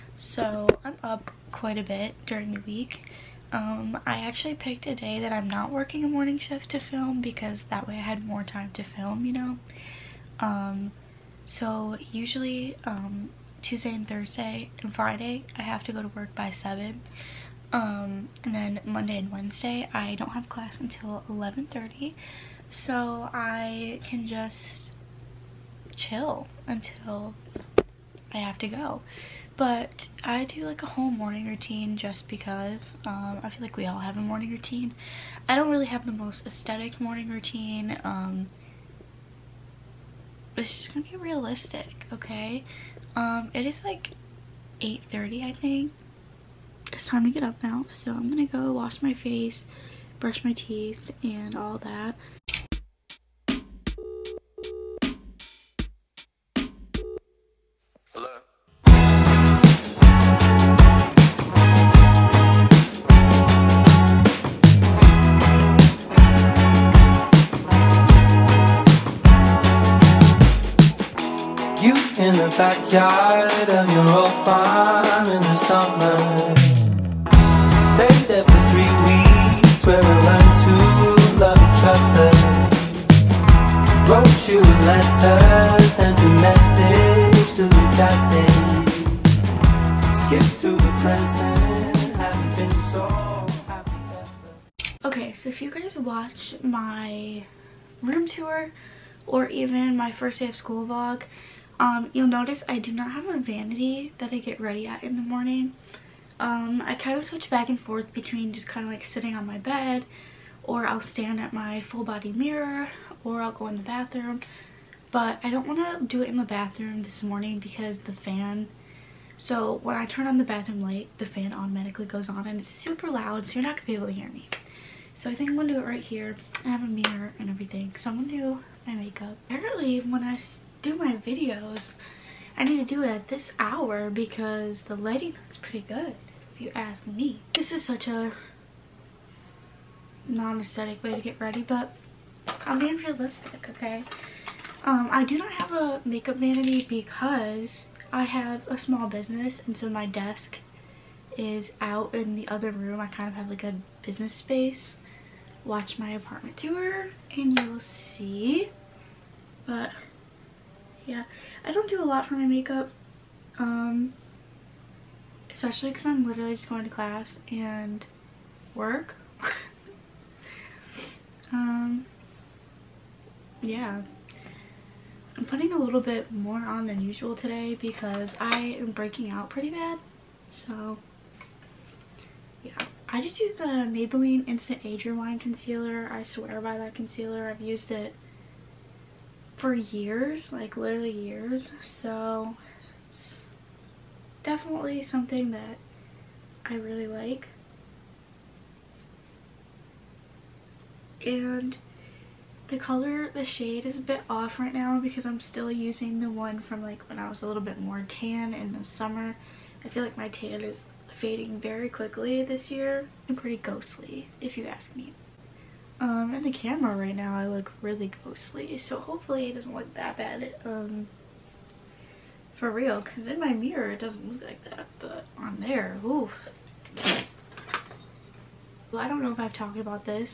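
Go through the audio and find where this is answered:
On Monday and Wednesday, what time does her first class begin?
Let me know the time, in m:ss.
0:21.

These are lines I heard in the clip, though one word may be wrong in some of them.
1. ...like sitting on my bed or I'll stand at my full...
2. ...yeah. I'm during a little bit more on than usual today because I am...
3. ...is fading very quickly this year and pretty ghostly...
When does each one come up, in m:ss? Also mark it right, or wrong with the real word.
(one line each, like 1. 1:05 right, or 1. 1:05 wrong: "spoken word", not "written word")
1. 1:48 right
2. 2:53 wrong: "putting", not "during"
3. 3:30 right.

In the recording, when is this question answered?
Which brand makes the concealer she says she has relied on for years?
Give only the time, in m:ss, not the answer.
3:03.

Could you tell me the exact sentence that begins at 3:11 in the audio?
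So it's definitely something that I really like.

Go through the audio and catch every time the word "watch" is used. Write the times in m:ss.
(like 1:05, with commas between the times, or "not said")
1:35, 2:35.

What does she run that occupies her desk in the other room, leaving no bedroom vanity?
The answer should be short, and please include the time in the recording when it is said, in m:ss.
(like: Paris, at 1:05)
A small business, at 2:28.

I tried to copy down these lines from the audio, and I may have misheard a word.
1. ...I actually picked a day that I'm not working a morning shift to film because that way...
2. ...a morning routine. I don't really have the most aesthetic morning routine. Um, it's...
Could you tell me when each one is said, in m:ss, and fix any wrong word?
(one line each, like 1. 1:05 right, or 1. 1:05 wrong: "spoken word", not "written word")
1. 0:04 right
2. 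0:34 right.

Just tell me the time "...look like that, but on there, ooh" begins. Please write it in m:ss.
3:44.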